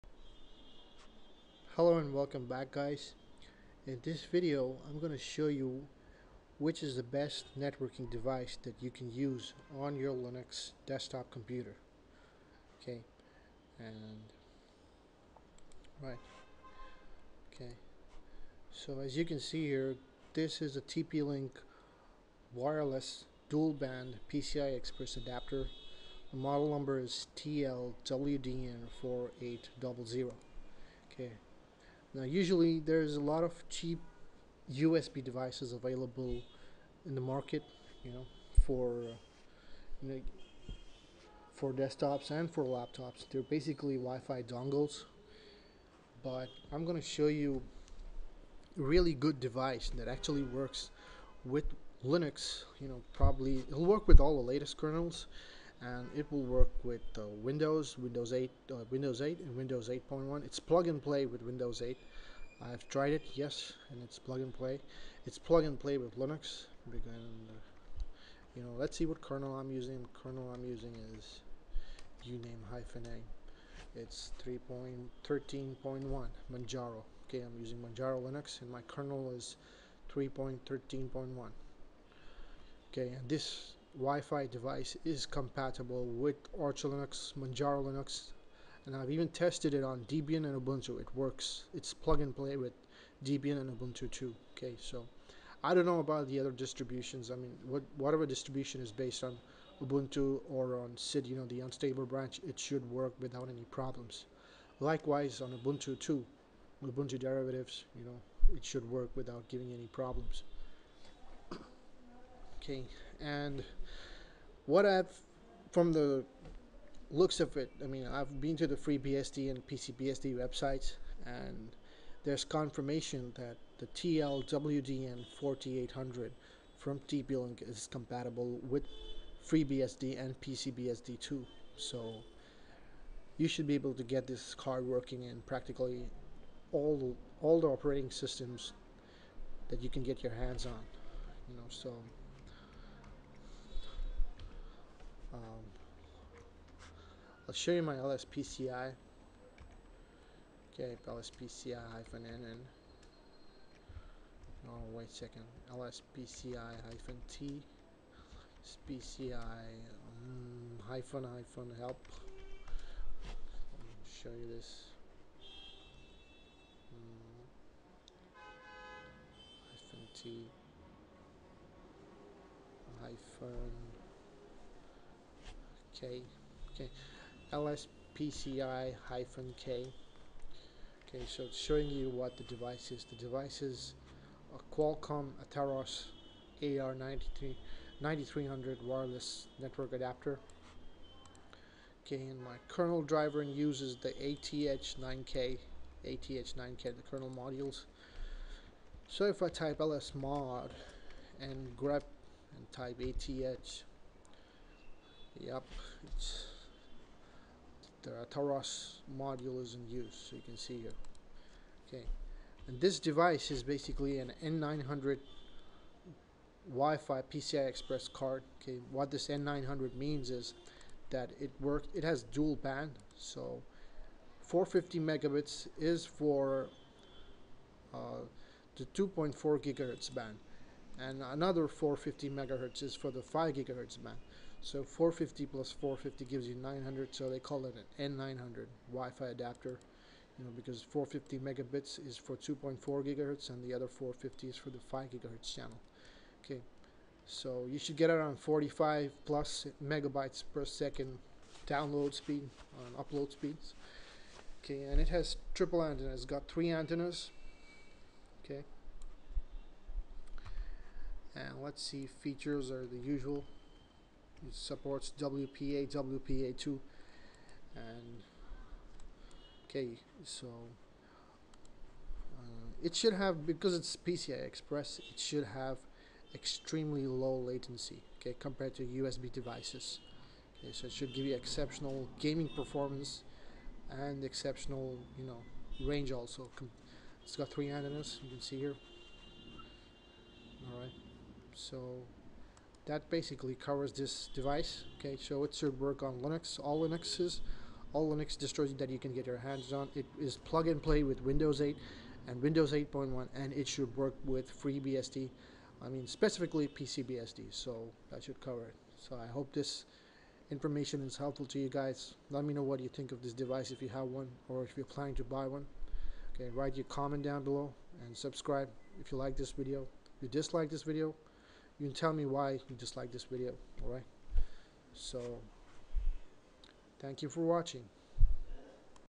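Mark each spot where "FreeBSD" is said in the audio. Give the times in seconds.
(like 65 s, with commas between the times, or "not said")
118 s, 129 s, 304 s.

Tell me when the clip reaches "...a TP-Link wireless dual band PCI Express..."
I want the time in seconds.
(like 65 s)
20 s.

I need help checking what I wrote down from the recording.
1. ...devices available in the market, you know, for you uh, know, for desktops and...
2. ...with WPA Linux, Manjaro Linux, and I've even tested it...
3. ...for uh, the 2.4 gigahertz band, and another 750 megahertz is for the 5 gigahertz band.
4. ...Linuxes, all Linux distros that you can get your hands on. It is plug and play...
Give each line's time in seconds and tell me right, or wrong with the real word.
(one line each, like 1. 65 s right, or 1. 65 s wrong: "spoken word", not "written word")
1. 35 s right
2. 86 s wrong: "Arch", not "WPA"
3. 226 s wrong: "450", not "750"
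4. 296 s right.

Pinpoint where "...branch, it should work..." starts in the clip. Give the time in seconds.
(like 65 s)
102 s.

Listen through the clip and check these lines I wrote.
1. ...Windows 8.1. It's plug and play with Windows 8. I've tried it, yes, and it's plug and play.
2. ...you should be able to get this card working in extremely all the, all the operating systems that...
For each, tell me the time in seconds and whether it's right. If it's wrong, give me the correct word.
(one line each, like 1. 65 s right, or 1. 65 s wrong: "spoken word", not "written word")
1. 59 s right
2. 133 s wrong: "practically", not "extremely".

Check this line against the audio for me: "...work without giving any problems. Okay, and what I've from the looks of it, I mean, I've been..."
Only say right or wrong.
right.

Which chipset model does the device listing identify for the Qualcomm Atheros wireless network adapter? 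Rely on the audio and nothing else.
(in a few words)
AR9300.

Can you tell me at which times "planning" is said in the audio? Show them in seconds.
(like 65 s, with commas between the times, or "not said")
314 s.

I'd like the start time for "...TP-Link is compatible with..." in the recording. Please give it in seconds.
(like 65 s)
127 s.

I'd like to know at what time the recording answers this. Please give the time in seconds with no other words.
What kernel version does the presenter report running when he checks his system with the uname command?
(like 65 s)
74 s.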